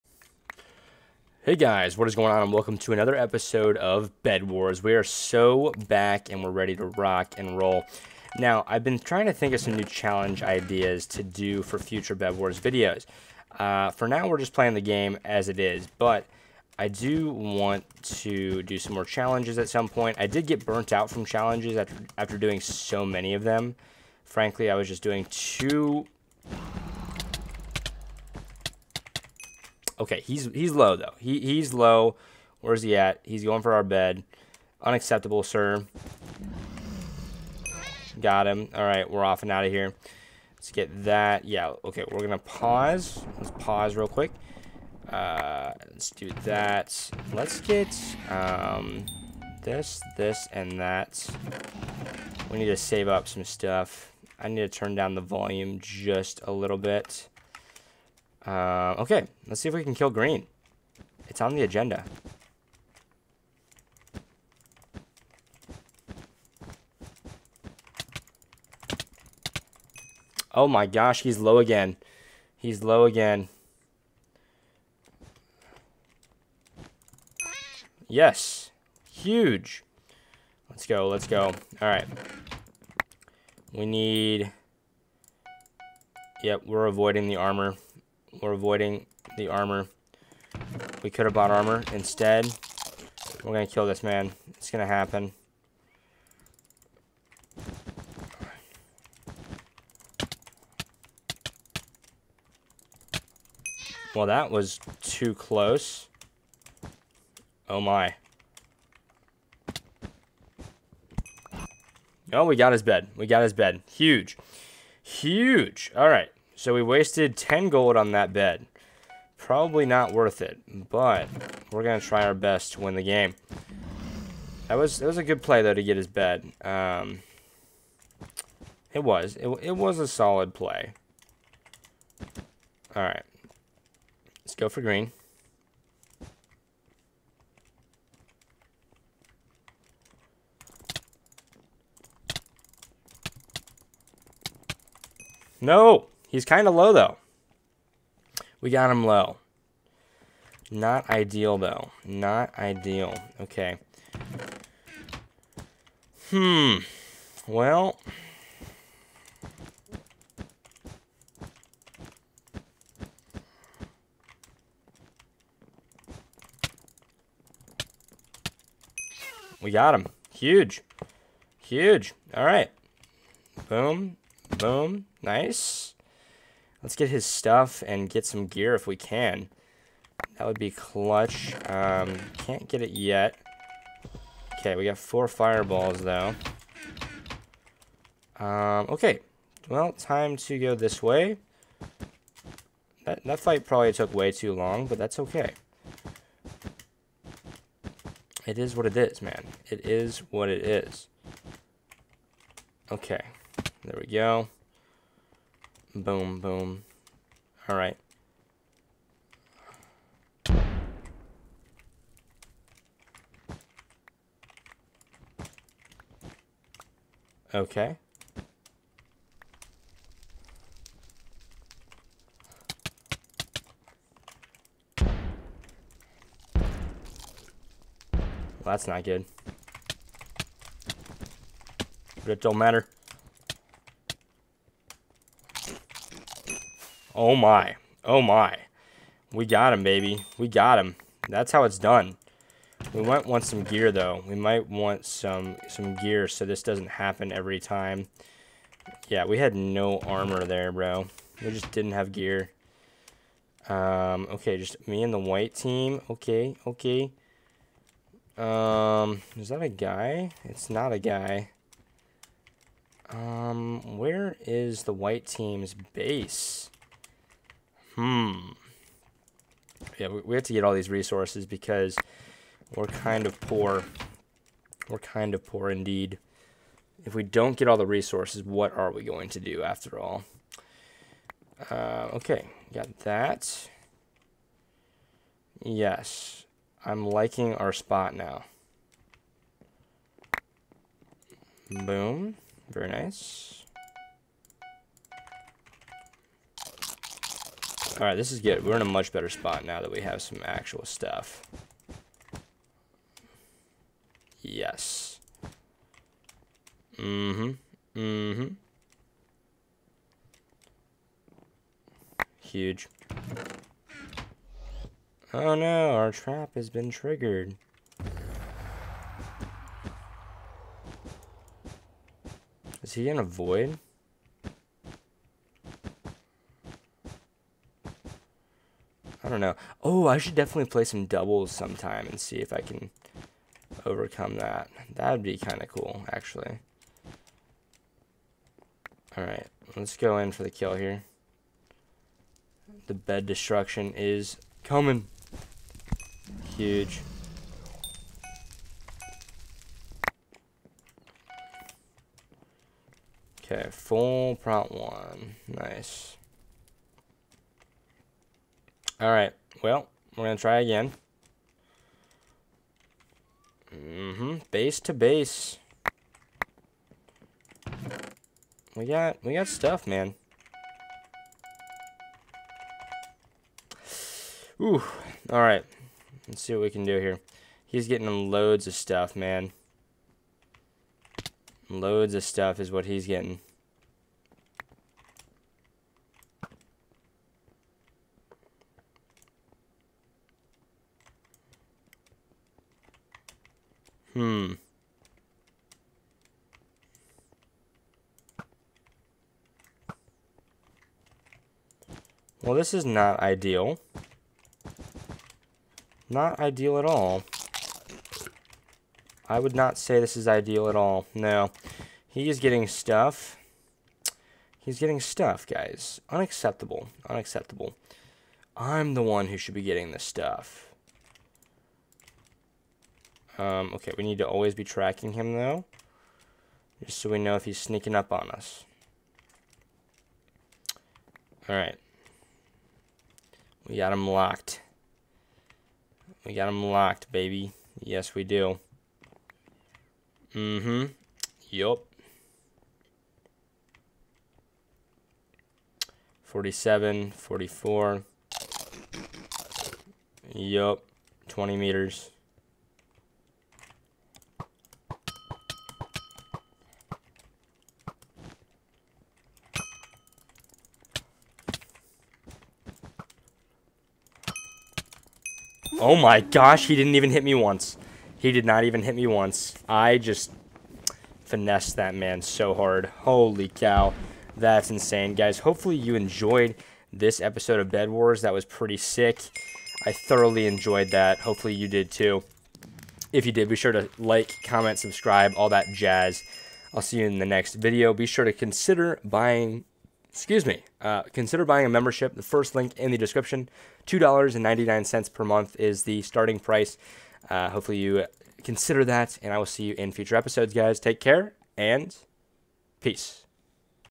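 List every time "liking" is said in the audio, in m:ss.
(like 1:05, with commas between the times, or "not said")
4:47.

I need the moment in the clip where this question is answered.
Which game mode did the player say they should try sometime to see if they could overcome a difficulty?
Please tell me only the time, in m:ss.
5:31.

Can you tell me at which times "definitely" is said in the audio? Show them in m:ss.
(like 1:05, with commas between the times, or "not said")
5:30.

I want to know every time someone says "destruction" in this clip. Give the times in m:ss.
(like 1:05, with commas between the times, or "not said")
5:43.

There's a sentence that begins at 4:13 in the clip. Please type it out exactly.
Um, okay, just me and the white team.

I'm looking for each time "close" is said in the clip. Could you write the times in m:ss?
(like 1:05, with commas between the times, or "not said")
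1:45.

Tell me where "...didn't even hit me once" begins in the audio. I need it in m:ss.
7:46.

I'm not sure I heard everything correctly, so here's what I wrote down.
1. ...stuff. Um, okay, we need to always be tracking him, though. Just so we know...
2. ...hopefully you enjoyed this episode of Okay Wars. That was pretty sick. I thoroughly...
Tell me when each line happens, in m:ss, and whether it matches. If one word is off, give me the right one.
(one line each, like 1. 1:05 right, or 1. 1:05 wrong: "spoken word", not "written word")
1. 7:00 right
2. 7:55 wrong: "Bed", not "Okay".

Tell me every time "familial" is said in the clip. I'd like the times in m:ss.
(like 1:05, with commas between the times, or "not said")
not said.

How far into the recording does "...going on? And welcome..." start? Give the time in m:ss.
0:02.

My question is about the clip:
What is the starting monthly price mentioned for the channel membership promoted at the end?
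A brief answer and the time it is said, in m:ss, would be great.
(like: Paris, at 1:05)
$2.99, at 8:13.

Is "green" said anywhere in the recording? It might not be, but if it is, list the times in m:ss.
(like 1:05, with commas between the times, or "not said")
1:00, 2:14.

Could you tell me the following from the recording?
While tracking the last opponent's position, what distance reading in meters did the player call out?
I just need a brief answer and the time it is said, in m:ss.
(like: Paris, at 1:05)
20 meters, at 7:31.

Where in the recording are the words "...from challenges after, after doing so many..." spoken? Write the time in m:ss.
0:21.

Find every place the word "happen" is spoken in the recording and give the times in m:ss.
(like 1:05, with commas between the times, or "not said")
1:34, 4:06.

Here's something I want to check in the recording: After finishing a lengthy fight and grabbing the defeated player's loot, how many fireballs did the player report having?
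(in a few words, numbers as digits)
4.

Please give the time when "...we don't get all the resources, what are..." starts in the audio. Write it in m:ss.
4:37.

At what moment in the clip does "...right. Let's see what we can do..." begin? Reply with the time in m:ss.
6:15.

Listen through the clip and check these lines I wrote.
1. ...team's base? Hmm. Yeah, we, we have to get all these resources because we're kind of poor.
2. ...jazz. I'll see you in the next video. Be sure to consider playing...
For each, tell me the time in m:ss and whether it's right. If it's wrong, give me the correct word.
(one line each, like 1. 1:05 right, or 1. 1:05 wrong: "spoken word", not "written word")
1. 4:25 right
2. 8:05 wrong: "buying", not "playing".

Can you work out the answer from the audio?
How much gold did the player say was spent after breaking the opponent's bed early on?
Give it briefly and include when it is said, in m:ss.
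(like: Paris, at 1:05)
10 gold, at 1:57.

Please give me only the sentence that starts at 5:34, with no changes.
That'd be kind of cool, actually.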